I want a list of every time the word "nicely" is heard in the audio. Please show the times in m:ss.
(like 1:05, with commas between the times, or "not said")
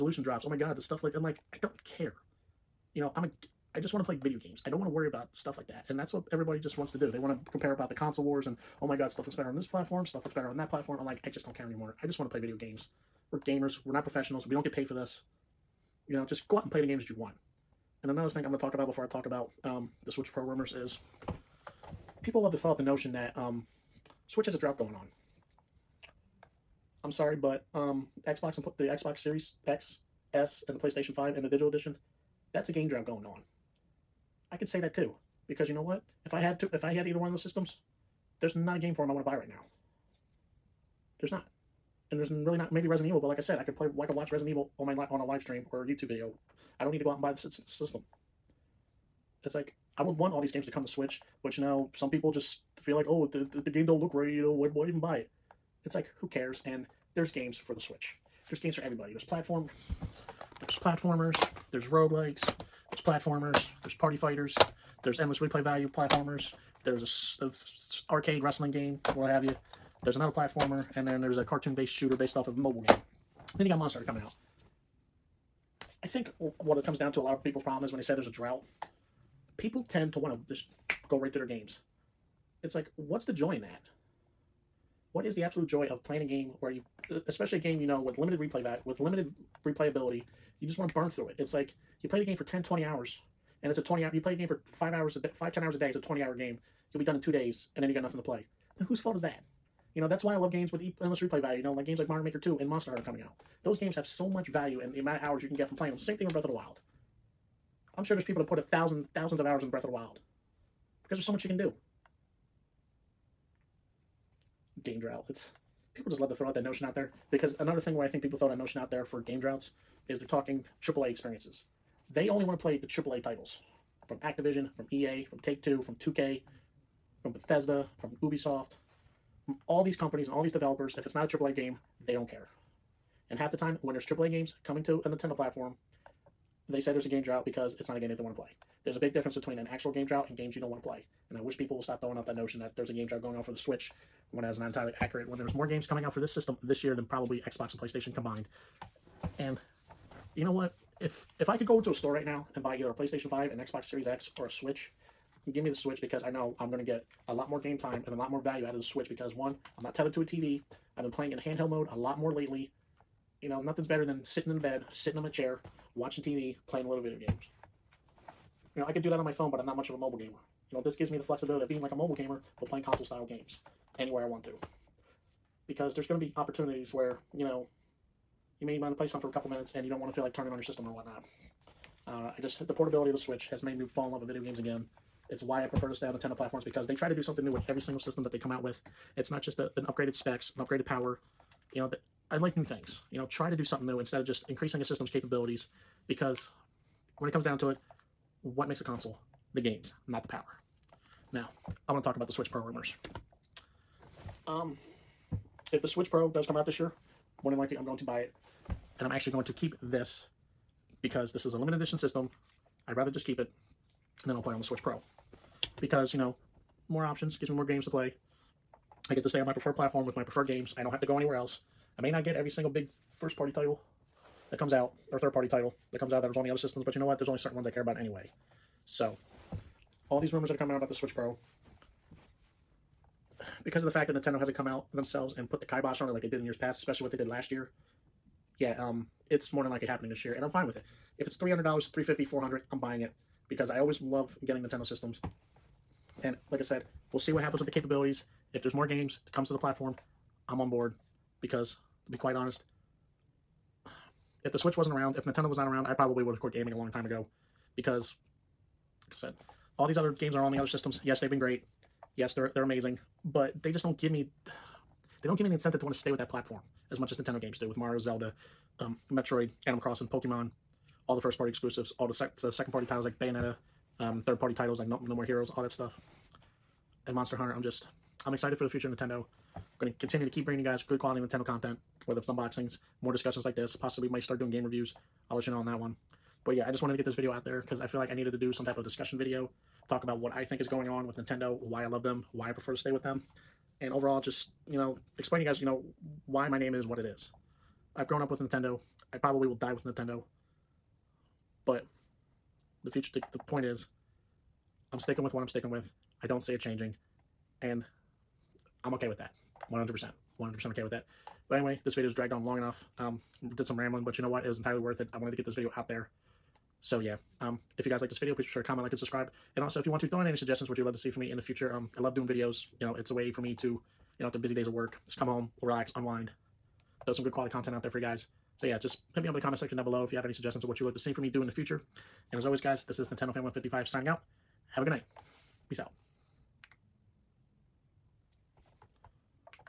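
not said.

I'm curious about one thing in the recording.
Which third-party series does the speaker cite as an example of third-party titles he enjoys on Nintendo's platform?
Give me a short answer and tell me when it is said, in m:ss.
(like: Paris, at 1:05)
No More Heroes, at 4:35.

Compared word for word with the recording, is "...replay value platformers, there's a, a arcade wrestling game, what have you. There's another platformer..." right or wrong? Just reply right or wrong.
right.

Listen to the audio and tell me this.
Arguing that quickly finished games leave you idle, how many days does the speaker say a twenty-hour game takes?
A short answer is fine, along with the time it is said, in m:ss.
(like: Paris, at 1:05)
2, at 1:37.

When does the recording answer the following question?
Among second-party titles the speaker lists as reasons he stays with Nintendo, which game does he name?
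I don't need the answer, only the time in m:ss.
4:33.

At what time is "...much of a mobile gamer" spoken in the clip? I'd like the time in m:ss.
2:49.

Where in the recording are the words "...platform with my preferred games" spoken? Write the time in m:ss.
3:39.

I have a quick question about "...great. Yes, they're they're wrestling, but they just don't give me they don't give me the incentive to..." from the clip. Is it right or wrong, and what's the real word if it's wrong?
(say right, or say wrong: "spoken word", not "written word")
wrong: "amazing", not "wrestling".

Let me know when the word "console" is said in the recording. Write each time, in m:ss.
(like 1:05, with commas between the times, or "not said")
0:07, 2:52, 3:18.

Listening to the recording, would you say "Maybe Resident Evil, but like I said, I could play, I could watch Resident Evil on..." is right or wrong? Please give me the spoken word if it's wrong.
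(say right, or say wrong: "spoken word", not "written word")
right.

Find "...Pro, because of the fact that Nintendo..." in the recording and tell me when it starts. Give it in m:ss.
3:51.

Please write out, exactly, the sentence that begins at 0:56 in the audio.
And there's games for the Switch.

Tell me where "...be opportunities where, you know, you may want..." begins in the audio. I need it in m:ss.
2:56.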